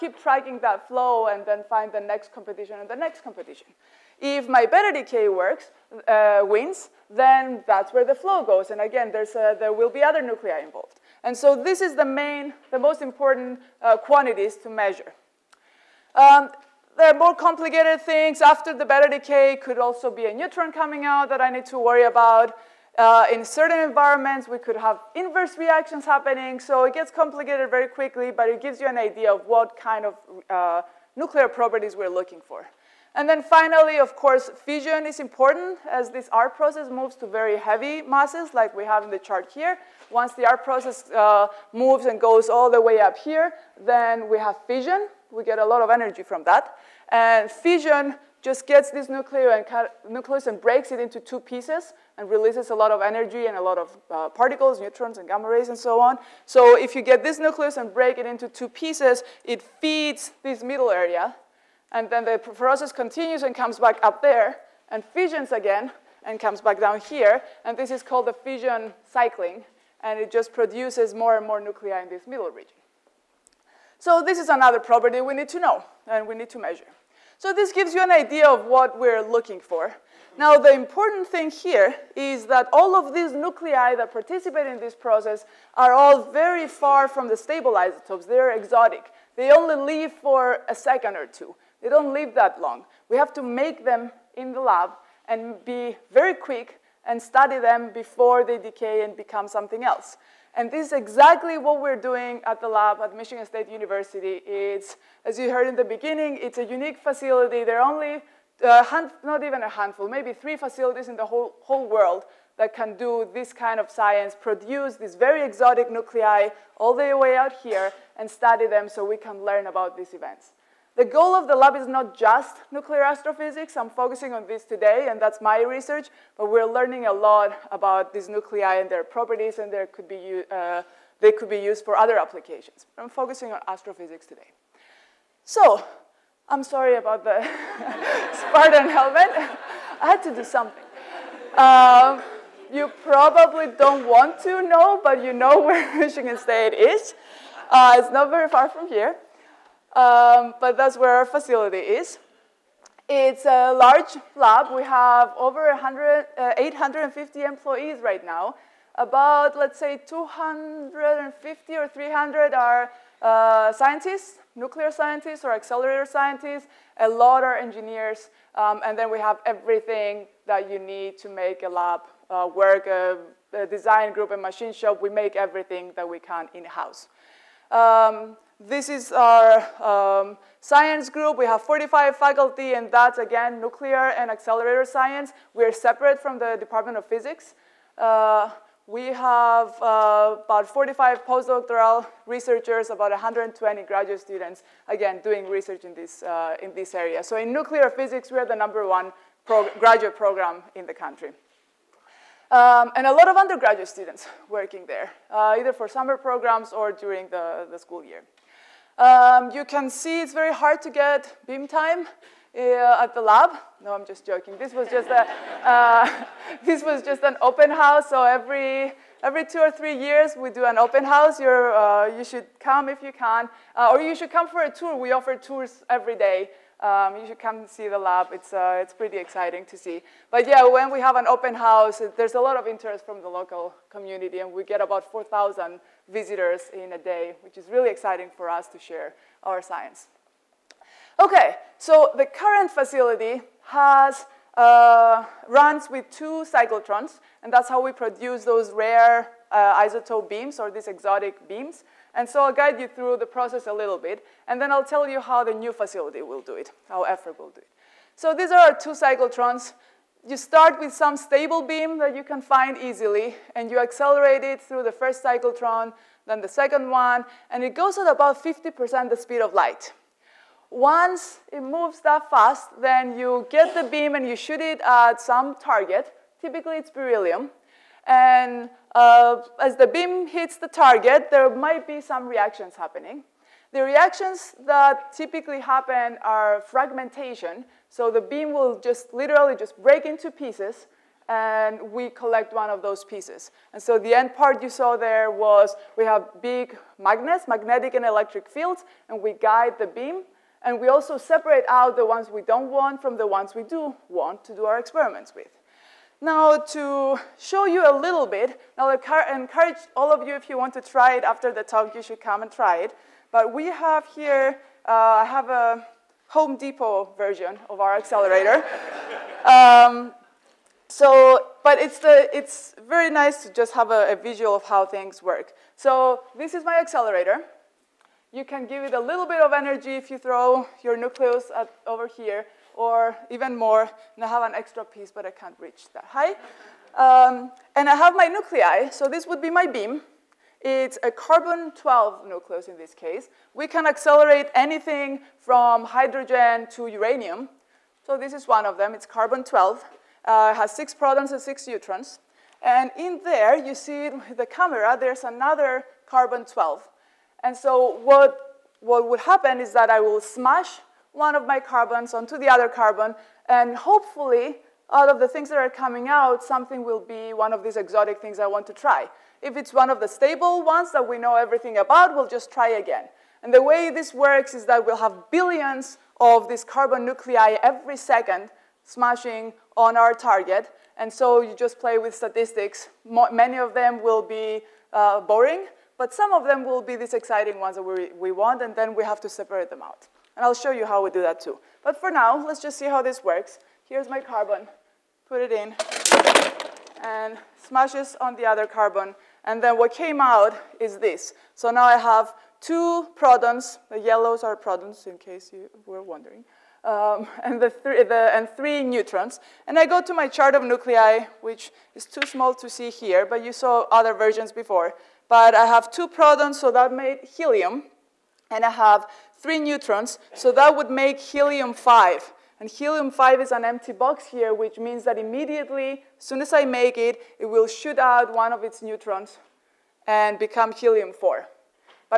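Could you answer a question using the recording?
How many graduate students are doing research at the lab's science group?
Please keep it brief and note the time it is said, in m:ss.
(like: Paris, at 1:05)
120, at 3:12.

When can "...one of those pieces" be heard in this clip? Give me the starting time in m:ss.
4:52.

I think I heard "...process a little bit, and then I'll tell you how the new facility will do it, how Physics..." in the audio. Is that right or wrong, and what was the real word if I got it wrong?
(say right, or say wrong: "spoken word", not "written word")
wrong: "FRIB", not "Physics".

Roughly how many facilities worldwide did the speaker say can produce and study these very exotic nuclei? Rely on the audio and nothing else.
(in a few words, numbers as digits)
3.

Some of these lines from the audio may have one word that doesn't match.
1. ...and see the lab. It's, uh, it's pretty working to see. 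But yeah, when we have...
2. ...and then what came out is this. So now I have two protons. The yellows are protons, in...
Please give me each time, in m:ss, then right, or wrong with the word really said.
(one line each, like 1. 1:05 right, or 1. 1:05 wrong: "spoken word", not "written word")
1. 3:47 wrong: "exciting", not "working"
2. 6:39 right.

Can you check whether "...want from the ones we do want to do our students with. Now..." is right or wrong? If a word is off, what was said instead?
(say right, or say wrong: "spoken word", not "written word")
wrong: "experiments", not "students".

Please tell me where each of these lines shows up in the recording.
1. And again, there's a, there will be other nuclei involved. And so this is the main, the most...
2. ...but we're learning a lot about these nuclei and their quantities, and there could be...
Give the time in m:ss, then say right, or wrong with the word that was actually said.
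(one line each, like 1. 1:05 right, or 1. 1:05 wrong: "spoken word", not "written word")
1. 0:08 right
2. 2:06 wrong: "properties", not "quantities".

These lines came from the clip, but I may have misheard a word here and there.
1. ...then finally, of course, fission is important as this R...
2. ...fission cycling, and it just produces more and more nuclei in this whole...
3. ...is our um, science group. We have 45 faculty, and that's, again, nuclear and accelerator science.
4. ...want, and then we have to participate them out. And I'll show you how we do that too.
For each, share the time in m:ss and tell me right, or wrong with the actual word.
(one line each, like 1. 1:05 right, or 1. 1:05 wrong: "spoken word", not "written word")
1. 0:33 right
2. 1:08 wrong: "middle", not "whole"
3. 2:58 right
4. 6:28 wrong: "separate", not "participate".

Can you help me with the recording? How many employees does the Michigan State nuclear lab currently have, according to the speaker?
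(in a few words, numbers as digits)
850.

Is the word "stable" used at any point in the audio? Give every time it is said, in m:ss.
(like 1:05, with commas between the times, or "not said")
1:27, 4:21, 6:10.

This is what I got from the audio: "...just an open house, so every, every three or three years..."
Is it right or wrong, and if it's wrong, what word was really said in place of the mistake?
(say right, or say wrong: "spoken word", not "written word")
wrong: "two", not "three".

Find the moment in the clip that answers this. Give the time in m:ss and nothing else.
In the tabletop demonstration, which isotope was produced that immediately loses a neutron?
7:01.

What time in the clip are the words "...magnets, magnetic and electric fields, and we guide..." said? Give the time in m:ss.
4:56.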